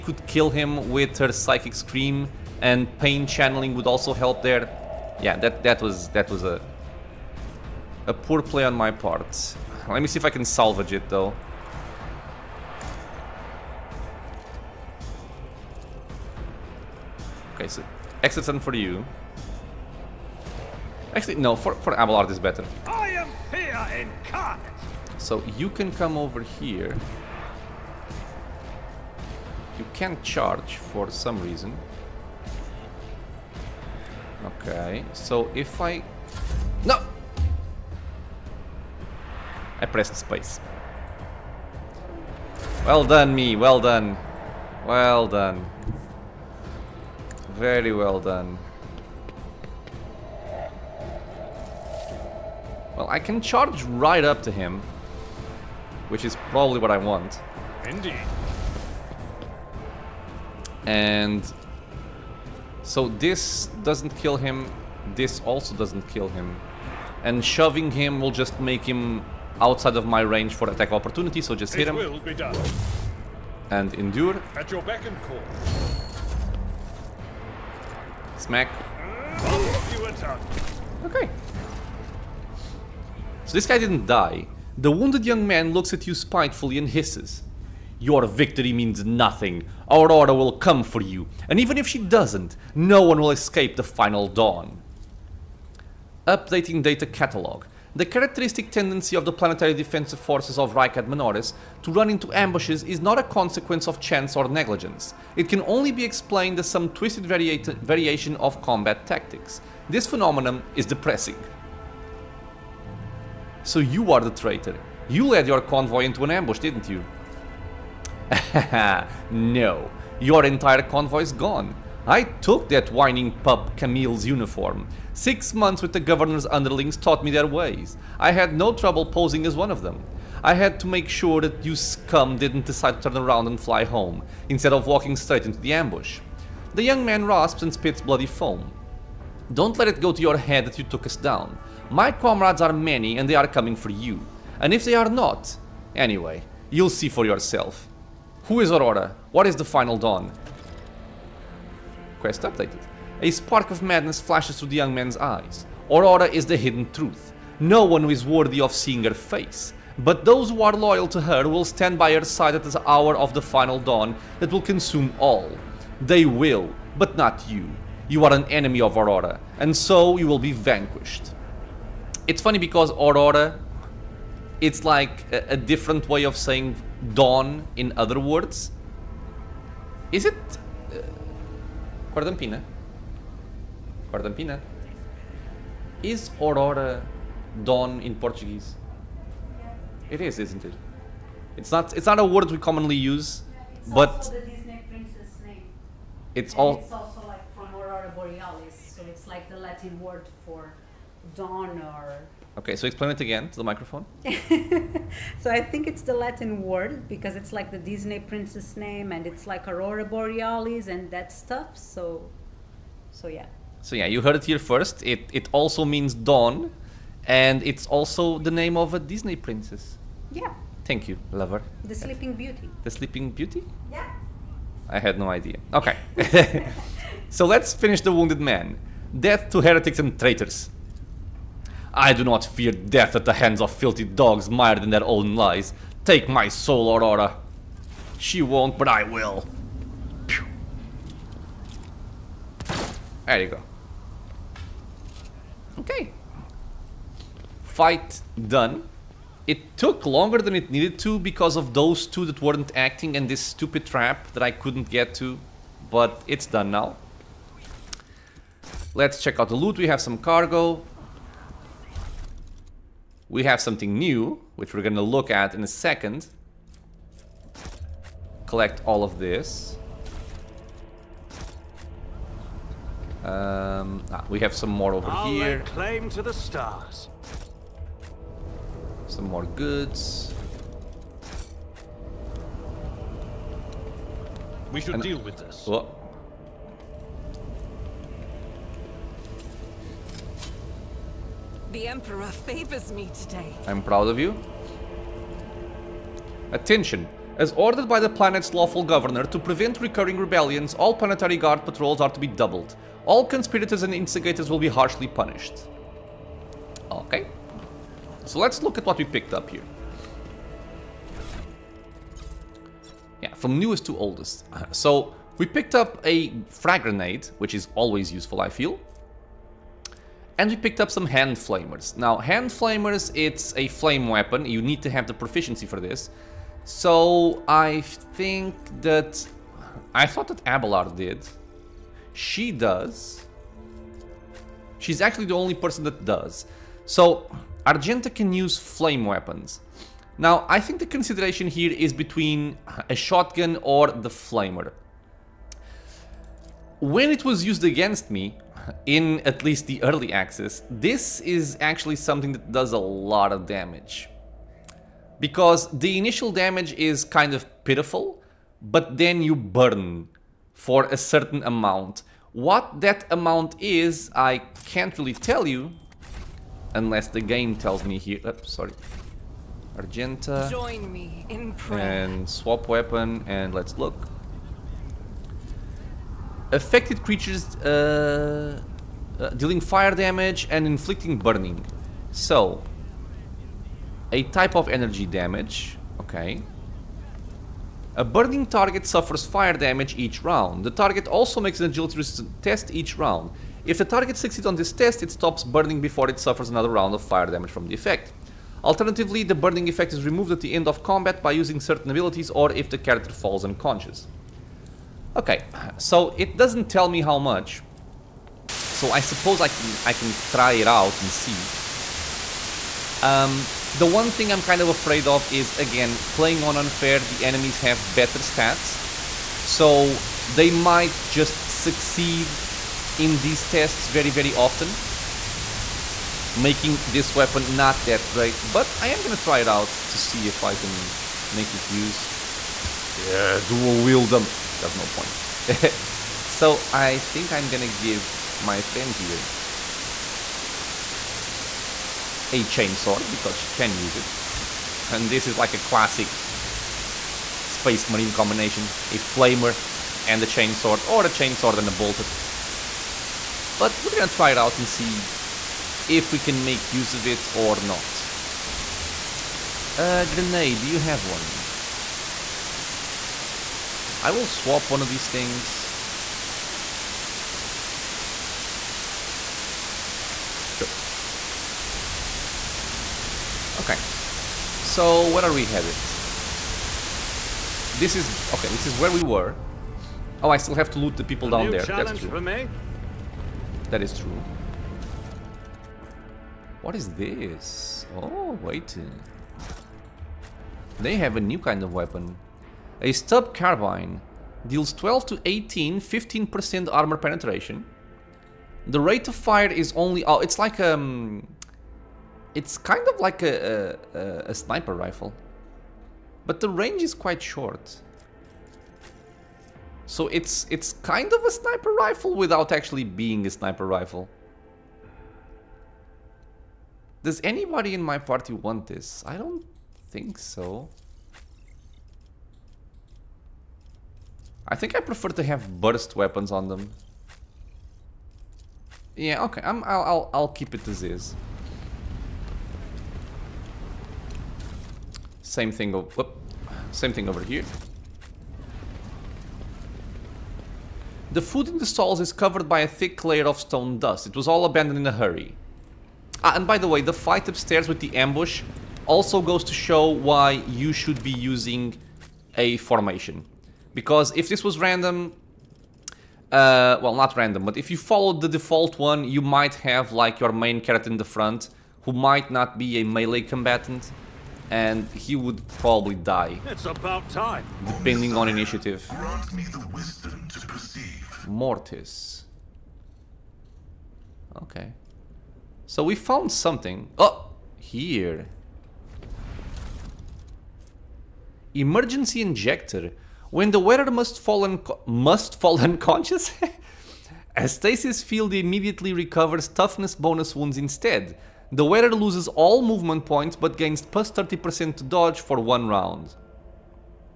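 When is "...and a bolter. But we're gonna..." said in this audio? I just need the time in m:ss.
7:31.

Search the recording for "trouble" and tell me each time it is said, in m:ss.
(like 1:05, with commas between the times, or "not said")
2:08.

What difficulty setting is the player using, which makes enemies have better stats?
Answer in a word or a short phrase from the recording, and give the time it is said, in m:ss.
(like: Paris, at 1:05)
unfair, at 6:56.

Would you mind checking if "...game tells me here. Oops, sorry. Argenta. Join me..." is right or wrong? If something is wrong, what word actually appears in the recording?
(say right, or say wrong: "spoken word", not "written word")
right.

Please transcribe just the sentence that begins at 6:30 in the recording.
The target also makes an agility test each round.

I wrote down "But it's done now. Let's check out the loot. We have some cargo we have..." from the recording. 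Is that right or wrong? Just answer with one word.
right.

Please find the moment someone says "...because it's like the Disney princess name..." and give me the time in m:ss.
3:27.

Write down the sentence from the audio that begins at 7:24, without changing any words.
And this is like a classic space marine combination.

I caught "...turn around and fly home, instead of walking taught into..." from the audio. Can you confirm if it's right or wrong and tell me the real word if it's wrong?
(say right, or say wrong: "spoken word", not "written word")
wrong: "straight", not "taught".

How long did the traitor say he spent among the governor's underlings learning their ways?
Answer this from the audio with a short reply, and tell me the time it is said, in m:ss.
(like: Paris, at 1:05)
6 months, at 2:05.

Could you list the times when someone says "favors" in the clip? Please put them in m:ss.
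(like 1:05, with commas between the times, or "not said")
4:52.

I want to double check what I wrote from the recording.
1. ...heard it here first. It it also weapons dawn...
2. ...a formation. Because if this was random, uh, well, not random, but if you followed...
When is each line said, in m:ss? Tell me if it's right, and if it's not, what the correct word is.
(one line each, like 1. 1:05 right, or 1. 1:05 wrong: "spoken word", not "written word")
1. 3:34 wrong: "means", not "weapons"
2. 9:12 right.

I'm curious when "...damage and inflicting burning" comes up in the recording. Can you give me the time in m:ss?
6:19.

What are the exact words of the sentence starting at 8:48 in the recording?
Yeah, okay, i will I'll, I'll keep it as is.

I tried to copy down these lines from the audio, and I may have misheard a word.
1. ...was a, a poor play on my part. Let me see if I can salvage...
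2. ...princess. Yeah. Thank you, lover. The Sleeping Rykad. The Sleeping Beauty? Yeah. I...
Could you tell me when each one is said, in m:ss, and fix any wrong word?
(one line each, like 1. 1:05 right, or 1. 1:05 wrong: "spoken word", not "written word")
1. 0:06 right
2. 3:39 wrong: "Beauty", not "Rykad".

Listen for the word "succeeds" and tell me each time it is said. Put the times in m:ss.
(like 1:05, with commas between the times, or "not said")
6:34, 7:01.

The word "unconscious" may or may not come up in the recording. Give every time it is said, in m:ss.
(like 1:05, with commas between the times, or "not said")
6:43, 9:45.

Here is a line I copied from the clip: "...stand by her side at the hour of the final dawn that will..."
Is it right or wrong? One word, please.
right.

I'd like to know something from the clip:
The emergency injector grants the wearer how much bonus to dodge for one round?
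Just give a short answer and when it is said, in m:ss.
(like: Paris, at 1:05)
30%, at 9:54.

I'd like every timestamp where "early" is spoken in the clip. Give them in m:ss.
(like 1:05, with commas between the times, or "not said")
5:49.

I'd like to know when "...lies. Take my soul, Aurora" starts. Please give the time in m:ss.
3:55.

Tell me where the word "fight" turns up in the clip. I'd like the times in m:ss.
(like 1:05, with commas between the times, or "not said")
4:07, 9:06.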